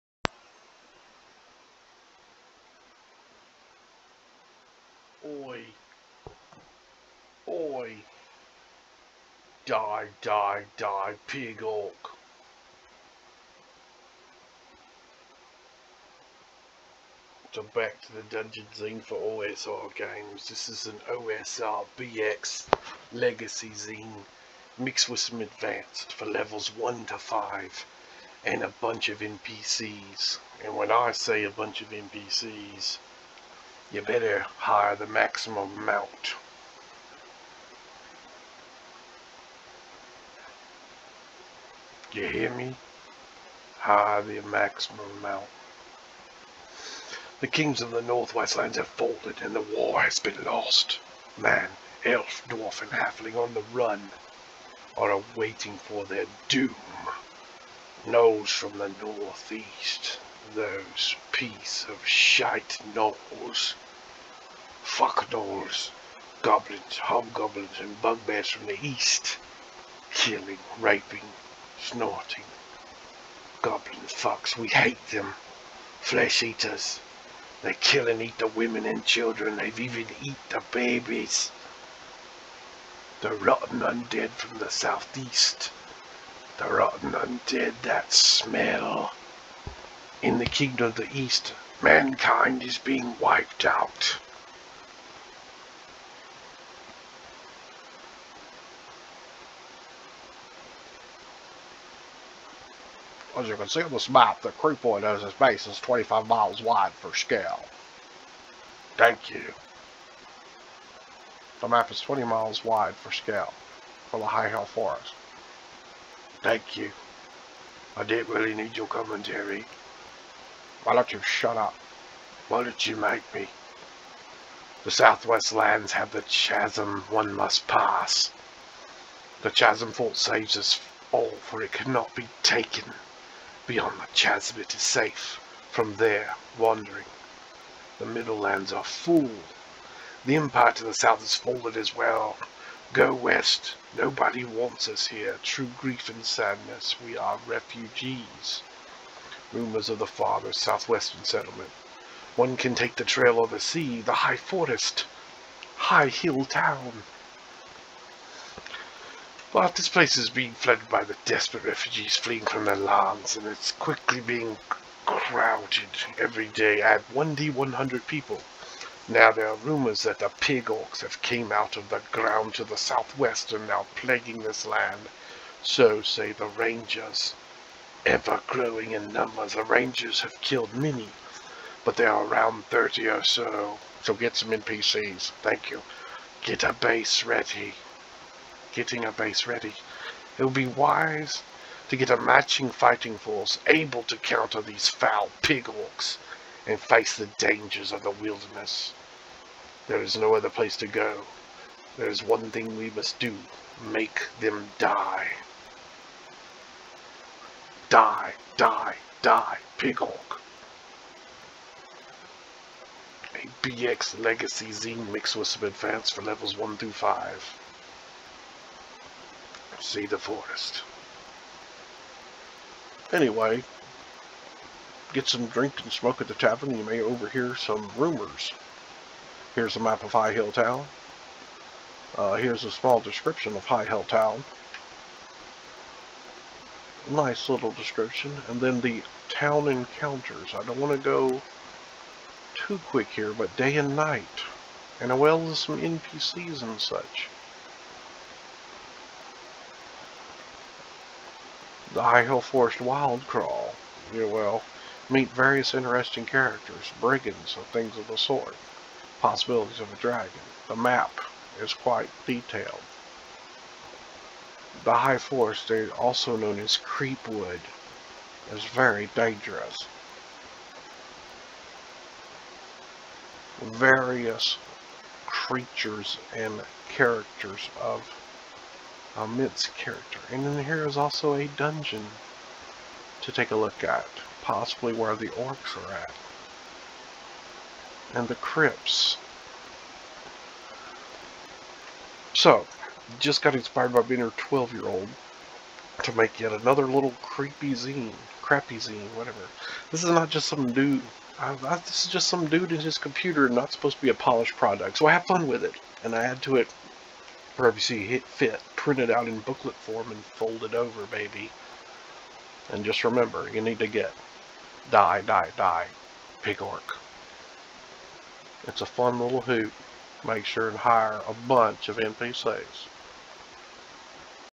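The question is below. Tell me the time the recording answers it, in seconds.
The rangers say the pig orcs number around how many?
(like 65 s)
182 s.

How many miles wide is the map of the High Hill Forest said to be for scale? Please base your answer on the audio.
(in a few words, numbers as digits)
20.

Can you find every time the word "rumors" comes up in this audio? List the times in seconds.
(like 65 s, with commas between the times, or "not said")
149 s, 169 s, 227 s.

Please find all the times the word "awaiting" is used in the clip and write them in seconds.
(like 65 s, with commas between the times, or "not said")
55 s.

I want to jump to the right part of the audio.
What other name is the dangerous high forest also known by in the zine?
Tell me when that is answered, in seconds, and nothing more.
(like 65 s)
266 s.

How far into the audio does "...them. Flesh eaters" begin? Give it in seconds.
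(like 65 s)
75 s.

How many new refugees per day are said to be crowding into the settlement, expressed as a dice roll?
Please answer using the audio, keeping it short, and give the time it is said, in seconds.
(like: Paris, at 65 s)
1D100, at 167 s.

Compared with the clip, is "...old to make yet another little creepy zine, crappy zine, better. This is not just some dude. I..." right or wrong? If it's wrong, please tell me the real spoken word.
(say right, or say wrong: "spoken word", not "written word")
wrong: "whatever", not "better".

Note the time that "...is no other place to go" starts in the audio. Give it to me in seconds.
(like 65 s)
200 s.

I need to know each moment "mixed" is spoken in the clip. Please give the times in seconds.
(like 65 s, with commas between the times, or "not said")
24 s, 215 s.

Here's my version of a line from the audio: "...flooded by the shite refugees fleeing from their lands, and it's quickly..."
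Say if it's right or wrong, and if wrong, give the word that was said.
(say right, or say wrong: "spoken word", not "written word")
wrong: "desperate", not "shite".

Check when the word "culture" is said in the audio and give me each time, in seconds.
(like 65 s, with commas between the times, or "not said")
not said.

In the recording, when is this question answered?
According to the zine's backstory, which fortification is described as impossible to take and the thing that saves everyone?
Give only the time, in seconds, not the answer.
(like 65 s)
129 s.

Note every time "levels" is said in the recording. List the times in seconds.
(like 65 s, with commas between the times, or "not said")
26 s, 216 s.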